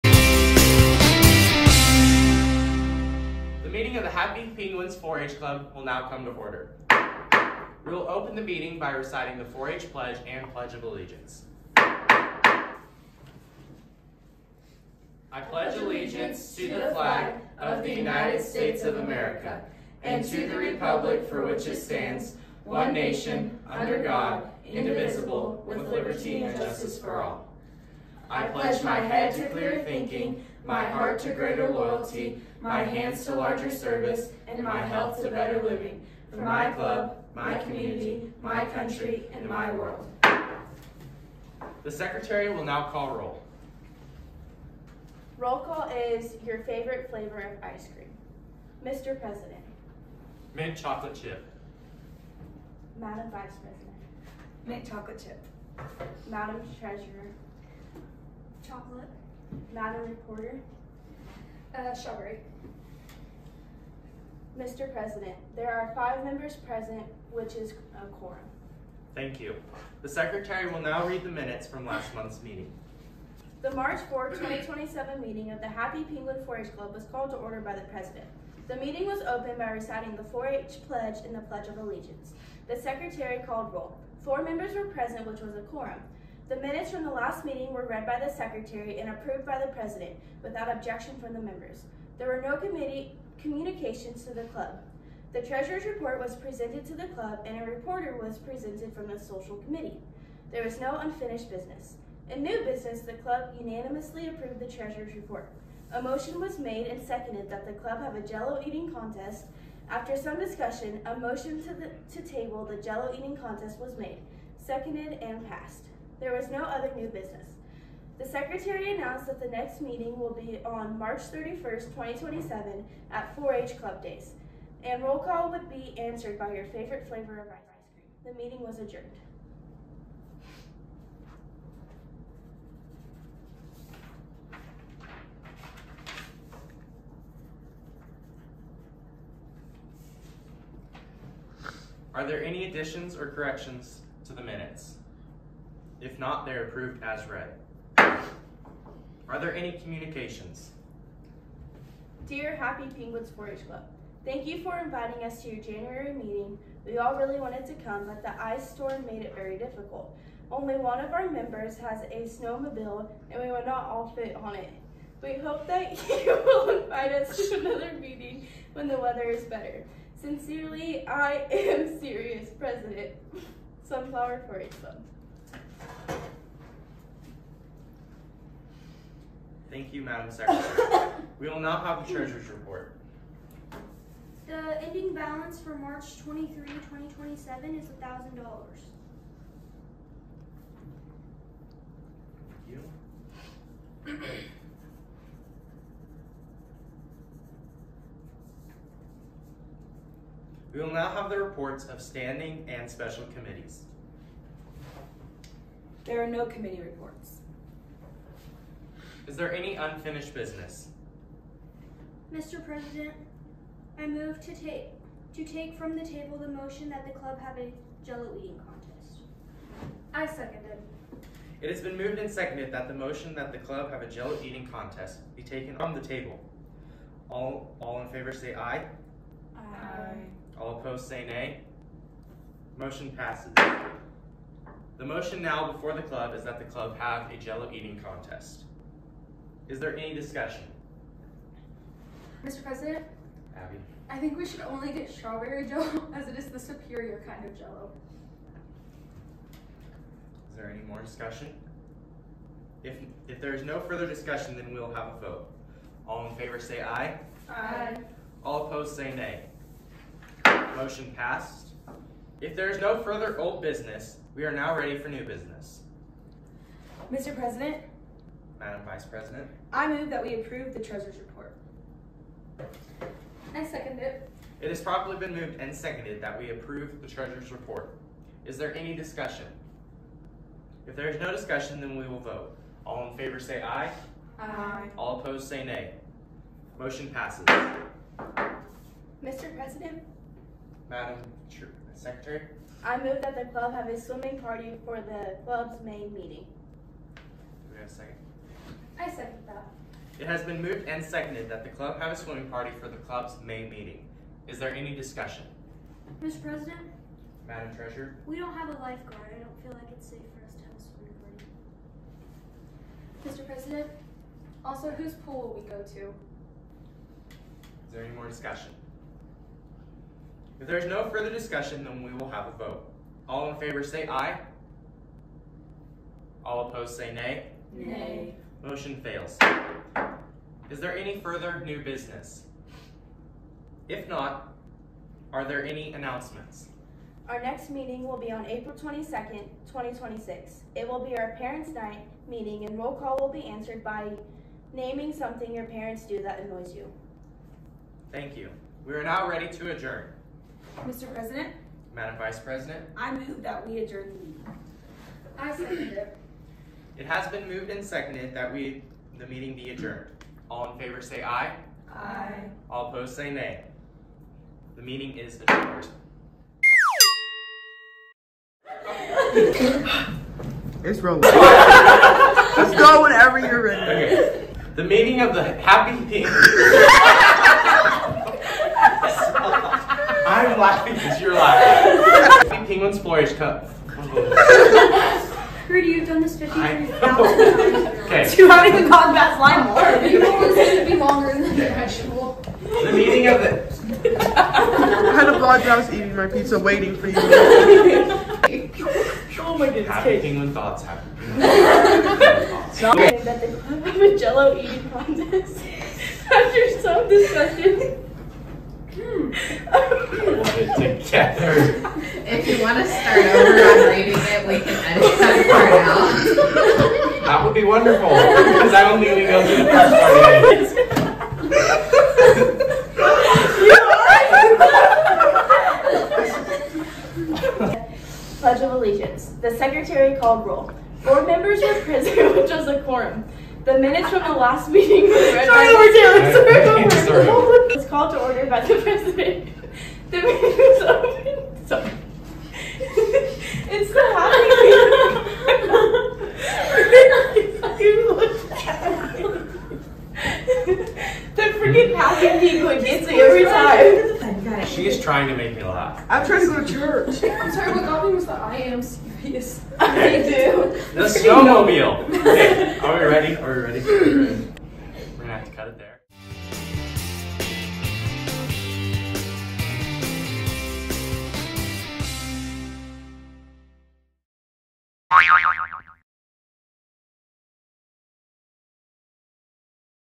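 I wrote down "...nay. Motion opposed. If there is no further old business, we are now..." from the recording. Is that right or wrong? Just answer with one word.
wrong.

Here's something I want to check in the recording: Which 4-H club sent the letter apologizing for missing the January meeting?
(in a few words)
Sunflower 4-H Club.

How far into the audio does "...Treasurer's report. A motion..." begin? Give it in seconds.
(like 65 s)
104 s.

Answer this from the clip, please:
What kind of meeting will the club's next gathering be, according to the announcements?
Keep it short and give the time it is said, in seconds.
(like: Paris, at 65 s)
Parents' Night, at 341 s.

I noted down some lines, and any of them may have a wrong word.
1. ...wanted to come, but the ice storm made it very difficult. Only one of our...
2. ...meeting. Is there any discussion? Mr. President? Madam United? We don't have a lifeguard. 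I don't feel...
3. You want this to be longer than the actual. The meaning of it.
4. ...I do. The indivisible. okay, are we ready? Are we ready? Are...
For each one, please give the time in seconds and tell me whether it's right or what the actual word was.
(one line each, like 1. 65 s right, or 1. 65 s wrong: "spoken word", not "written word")
1. 157 s right
2. 303 s wrong: "Treasurer", not "United"
3. 390 s right
4. 459 s wrong: "snowmobile", not "indivisible".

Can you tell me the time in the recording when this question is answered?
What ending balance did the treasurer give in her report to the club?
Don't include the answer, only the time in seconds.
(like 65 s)
187 s.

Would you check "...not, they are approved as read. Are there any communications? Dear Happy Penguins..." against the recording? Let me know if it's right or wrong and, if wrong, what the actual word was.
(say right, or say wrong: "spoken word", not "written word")
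right.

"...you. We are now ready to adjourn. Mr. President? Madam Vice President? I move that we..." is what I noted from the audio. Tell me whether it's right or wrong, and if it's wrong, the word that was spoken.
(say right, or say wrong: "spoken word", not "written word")
right.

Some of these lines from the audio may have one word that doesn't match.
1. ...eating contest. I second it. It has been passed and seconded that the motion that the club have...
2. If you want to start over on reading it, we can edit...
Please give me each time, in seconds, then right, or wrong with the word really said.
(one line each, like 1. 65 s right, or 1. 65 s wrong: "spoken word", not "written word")
1. 218 s wrong: "moved", not "passed"
2. 412 s right.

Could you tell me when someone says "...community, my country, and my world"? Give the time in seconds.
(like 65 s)
37 s.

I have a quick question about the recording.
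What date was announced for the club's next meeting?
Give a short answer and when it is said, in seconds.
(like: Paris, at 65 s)
April 22nd, 2026, at 338 s.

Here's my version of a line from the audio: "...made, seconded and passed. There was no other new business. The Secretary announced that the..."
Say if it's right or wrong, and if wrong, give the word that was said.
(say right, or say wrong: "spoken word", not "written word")
right.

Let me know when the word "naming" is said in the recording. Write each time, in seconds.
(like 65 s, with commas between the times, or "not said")
344 s.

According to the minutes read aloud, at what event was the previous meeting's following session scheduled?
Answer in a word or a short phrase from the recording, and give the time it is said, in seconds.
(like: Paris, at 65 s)
4-H Club Days, at 123 s.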